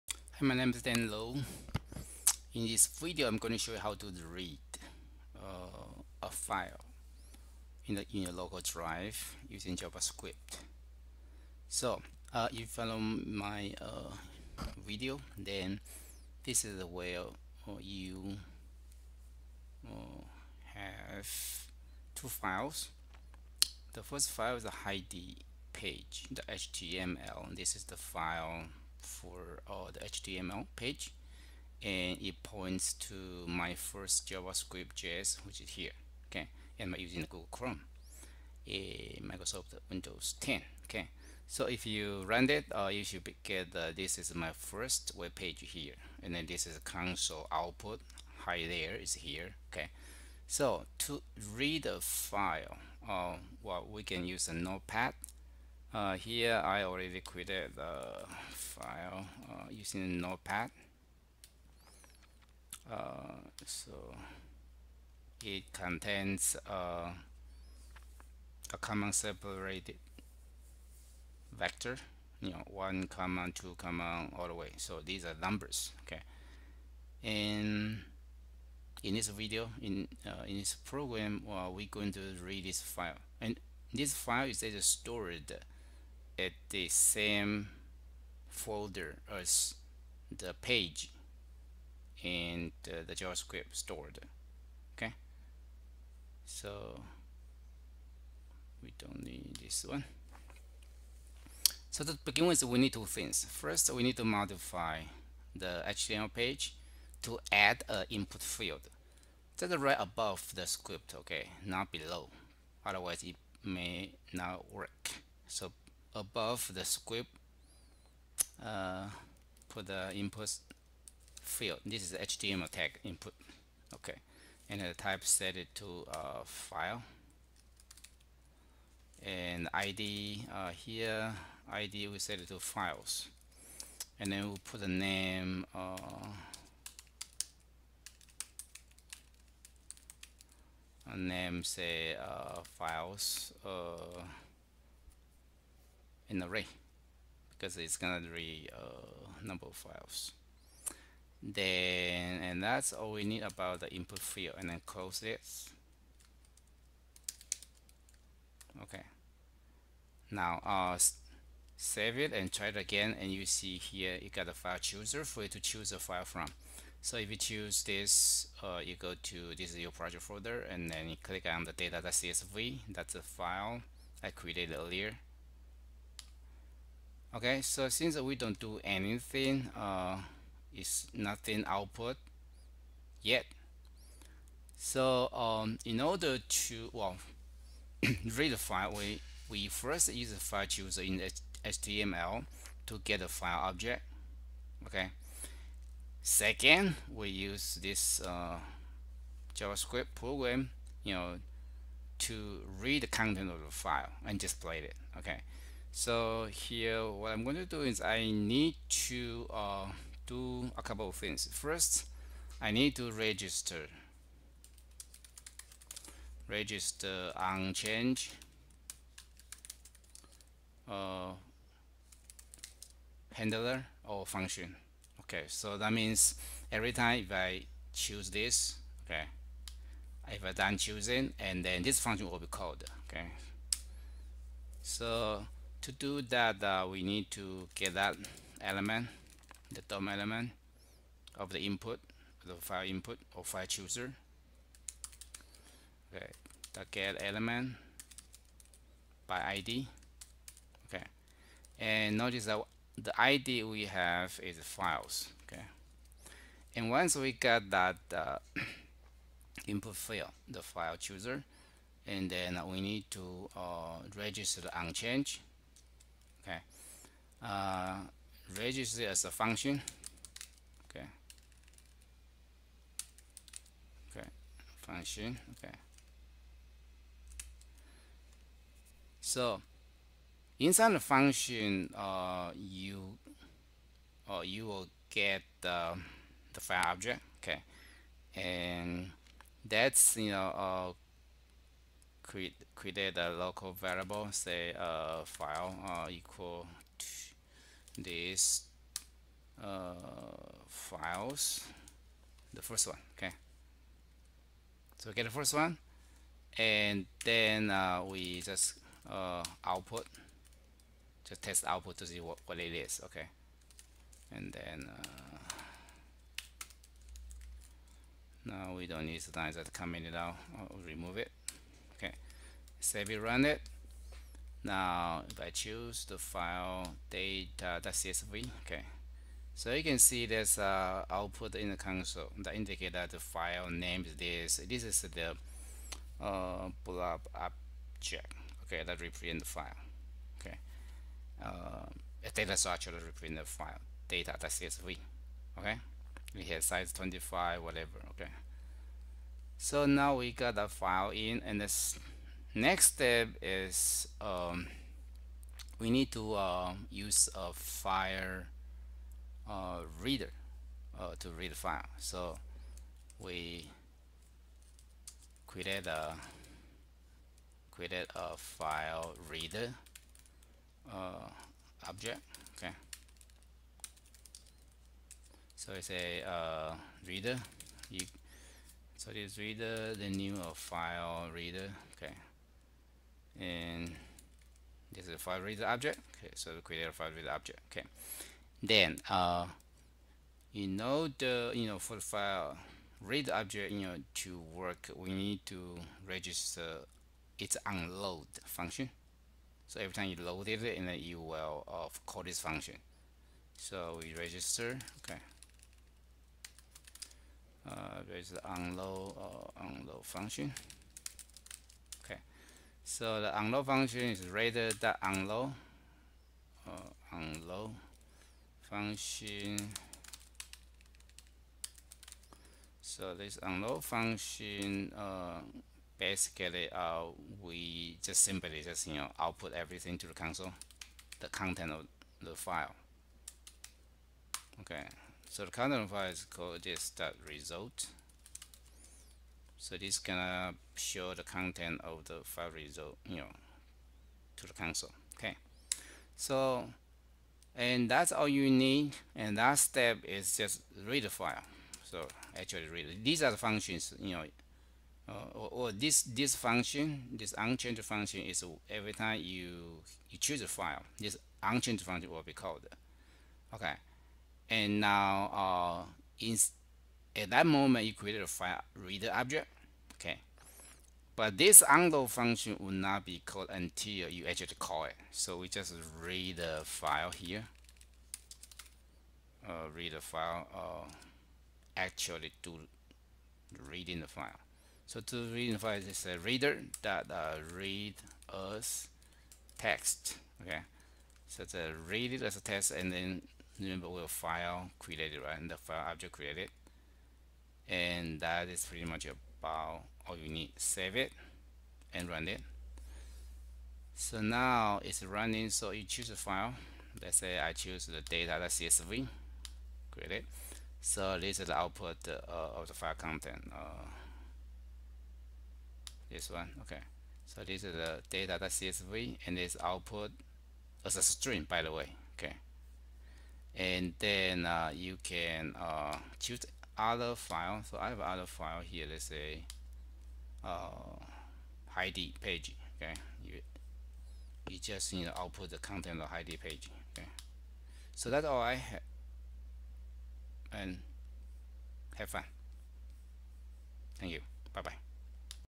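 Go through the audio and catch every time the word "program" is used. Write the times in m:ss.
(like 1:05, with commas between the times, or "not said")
1:20, 3:20.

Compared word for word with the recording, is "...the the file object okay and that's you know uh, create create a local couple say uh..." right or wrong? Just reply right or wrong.
wrong.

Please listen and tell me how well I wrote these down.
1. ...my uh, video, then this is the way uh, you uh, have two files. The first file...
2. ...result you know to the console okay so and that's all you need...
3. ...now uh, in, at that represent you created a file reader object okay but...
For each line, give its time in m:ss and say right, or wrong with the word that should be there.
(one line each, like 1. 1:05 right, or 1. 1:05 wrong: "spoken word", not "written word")
1. 0:12 right
2. 7:22 right
3. 7:44 wrong: "moment", not "represent".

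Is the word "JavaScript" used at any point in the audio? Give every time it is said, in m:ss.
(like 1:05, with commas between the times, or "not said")
0:09, 0:34, 1:33, 3:19.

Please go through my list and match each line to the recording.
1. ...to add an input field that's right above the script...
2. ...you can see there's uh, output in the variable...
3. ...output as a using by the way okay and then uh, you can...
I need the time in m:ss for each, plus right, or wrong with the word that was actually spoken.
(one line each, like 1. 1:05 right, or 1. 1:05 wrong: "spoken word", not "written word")
1. 1:47 right
2. 5:29 wrong: "console", not "variable"
3. 8:39 wrong: "string", not "using".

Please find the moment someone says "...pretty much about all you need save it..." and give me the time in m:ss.
8:18.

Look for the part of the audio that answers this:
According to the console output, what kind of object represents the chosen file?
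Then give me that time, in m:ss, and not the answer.
5:36.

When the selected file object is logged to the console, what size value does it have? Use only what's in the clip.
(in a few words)
25.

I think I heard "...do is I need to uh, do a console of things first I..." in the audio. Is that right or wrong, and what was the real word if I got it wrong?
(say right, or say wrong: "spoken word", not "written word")
wrong: "couple", not "console".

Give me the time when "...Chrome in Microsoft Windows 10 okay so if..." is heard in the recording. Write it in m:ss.
0:37.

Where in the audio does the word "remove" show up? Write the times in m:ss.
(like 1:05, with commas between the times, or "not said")
5:20.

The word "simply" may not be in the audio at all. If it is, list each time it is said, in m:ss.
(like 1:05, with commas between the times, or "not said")
7:08.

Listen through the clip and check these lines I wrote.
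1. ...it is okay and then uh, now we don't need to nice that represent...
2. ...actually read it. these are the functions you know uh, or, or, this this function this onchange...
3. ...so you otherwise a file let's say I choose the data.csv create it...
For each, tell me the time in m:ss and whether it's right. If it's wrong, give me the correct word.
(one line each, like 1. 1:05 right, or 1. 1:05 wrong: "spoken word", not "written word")
1. 5:12 wrong: "comment", not "represent"
2. 7:32 right
3. 8:25 wrong: "choose", not "otherwise".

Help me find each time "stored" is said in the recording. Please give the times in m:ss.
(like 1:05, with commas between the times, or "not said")
1:24, 1:33.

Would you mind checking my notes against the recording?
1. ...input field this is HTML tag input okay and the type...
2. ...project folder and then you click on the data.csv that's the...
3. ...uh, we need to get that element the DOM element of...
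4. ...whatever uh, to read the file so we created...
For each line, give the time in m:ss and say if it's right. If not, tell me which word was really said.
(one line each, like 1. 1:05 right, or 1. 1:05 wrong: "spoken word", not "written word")
1. 2:00 right
2. 2:49 right
3. 3:56 right
4. 6:00 wrong: "reader", not "whatever".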